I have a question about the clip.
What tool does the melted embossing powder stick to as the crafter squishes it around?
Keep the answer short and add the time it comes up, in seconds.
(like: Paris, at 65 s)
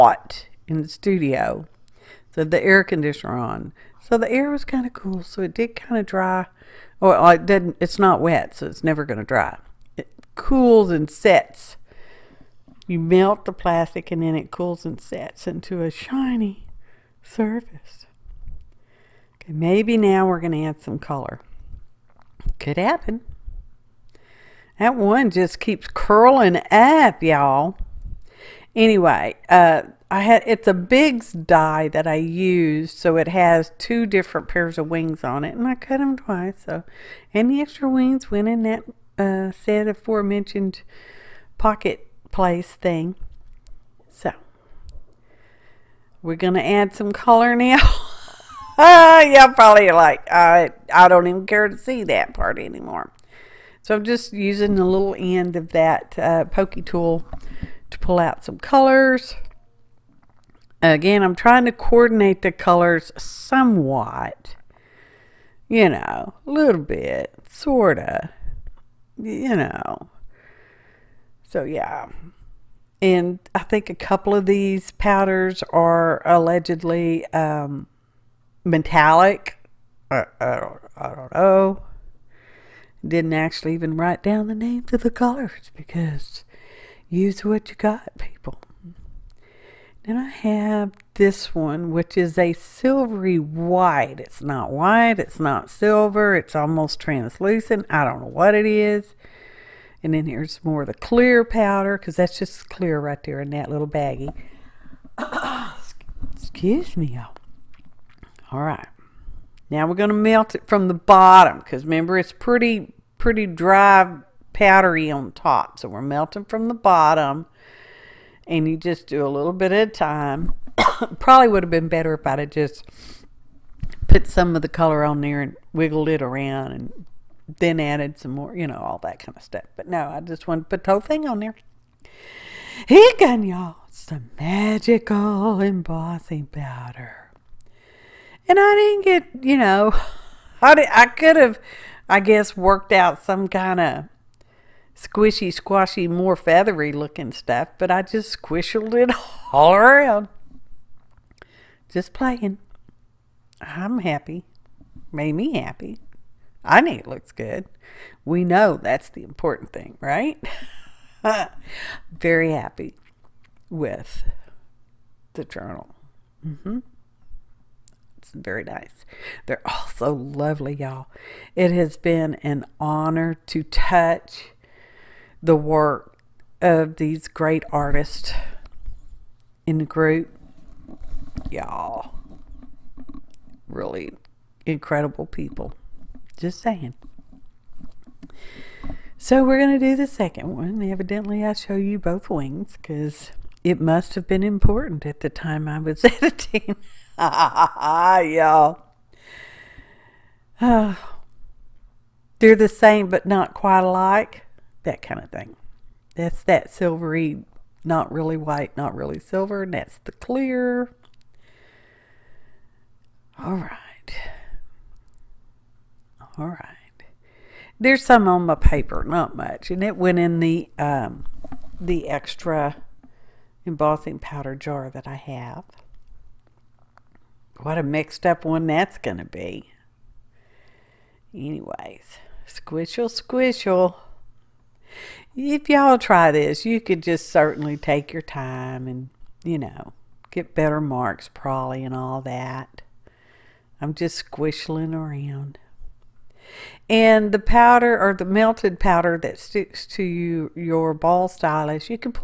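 ball stylus, at 250 s.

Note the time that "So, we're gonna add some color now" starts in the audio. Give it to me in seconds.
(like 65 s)
44 s.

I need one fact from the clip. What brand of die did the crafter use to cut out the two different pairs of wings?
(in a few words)
Bigz.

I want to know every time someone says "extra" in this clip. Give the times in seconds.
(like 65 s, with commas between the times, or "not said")
37 s, 222 s.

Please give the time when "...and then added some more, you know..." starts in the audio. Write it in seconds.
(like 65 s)
126 s.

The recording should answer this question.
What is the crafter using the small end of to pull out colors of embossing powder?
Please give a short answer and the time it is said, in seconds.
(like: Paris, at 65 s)
pokey tool, at 56 s.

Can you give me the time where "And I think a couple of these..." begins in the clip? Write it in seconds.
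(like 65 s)
73 s.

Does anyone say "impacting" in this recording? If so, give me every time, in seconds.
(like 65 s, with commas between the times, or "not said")
not said.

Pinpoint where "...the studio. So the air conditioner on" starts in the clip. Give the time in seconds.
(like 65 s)
0 s.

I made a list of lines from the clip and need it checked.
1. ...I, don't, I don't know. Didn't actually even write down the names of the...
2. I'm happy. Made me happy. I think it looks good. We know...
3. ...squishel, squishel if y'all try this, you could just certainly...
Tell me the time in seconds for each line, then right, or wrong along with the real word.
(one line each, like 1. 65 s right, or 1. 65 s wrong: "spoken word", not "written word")
1. 80 s right
2. 153 s right
3. 232 s right.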